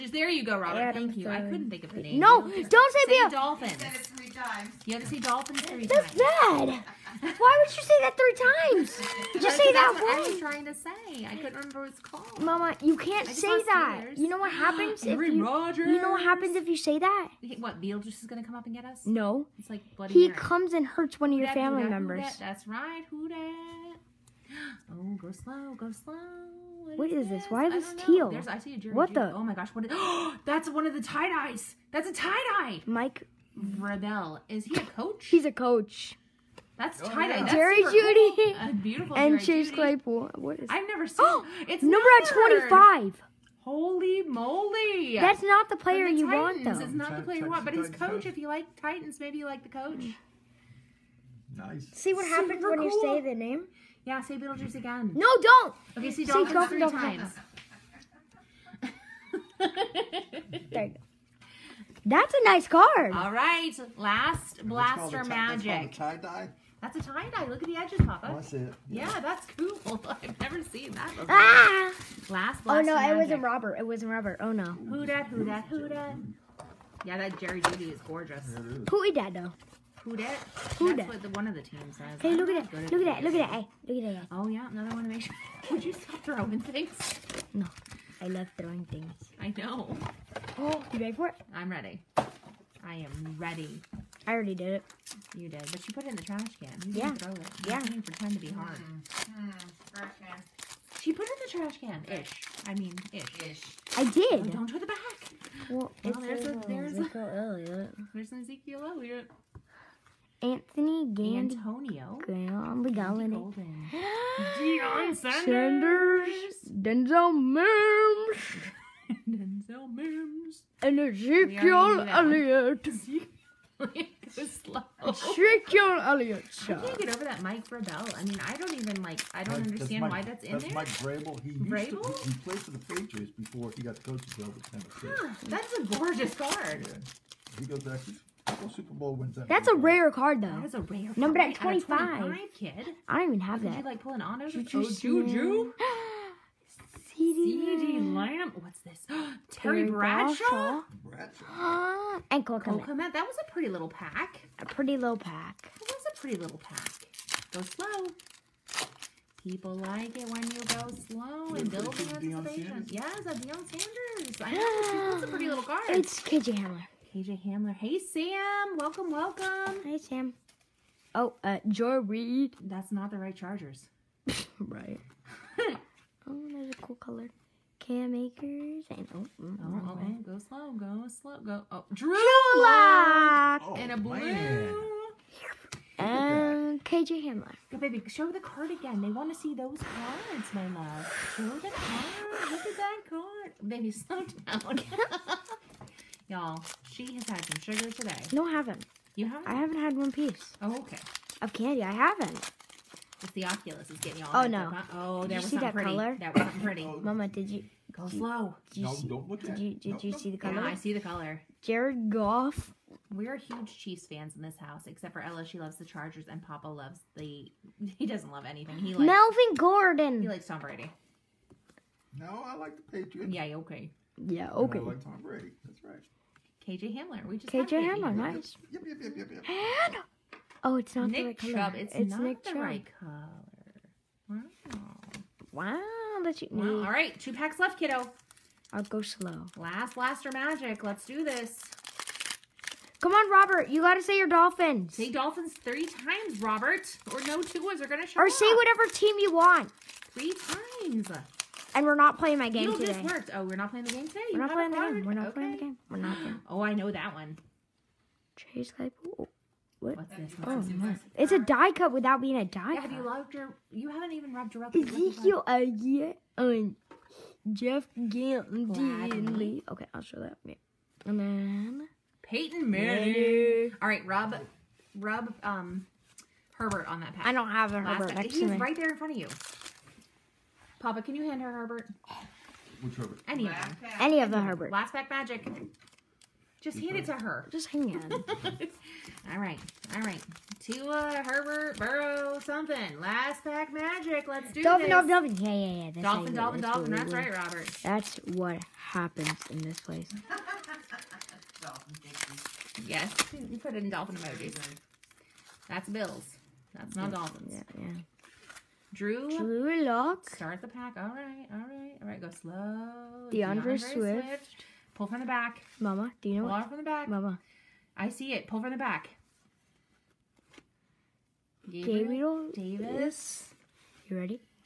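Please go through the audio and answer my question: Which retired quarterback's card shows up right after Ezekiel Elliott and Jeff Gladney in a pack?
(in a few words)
Peyton Manning.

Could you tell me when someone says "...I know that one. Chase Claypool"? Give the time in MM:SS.
04:16.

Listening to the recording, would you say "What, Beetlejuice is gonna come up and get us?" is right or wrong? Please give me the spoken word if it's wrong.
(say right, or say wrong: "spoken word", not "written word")
right.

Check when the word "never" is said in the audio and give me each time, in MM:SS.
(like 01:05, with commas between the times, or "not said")
00:40, 01:10.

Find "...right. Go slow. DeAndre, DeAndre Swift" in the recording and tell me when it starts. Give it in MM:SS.
05:12.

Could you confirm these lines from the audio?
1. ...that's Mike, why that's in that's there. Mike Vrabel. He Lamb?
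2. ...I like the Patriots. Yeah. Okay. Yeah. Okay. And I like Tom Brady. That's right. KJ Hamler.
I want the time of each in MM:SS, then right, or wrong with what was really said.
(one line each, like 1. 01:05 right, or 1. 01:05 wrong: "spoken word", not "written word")
1. 02:09 wrong: "Grable", not "Lamb"
2. 03:42 right.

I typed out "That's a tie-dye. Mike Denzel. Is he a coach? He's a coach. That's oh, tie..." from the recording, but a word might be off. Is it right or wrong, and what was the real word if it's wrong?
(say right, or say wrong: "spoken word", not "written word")
wrong: "Vrabel", not "Denzel".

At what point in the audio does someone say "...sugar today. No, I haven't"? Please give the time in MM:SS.
03:17.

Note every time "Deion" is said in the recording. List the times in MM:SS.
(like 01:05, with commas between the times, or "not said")
01:54, 02:43.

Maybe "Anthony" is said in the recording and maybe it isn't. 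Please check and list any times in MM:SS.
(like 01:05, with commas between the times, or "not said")
01:50.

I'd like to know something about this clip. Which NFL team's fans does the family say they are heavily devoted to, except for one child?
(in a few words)
Chiefs.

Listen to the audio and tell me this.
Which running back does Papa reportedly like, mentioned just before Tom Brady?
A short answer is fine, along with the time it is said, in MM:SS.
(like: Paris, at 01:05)
Melvin Gordon, at 03:39.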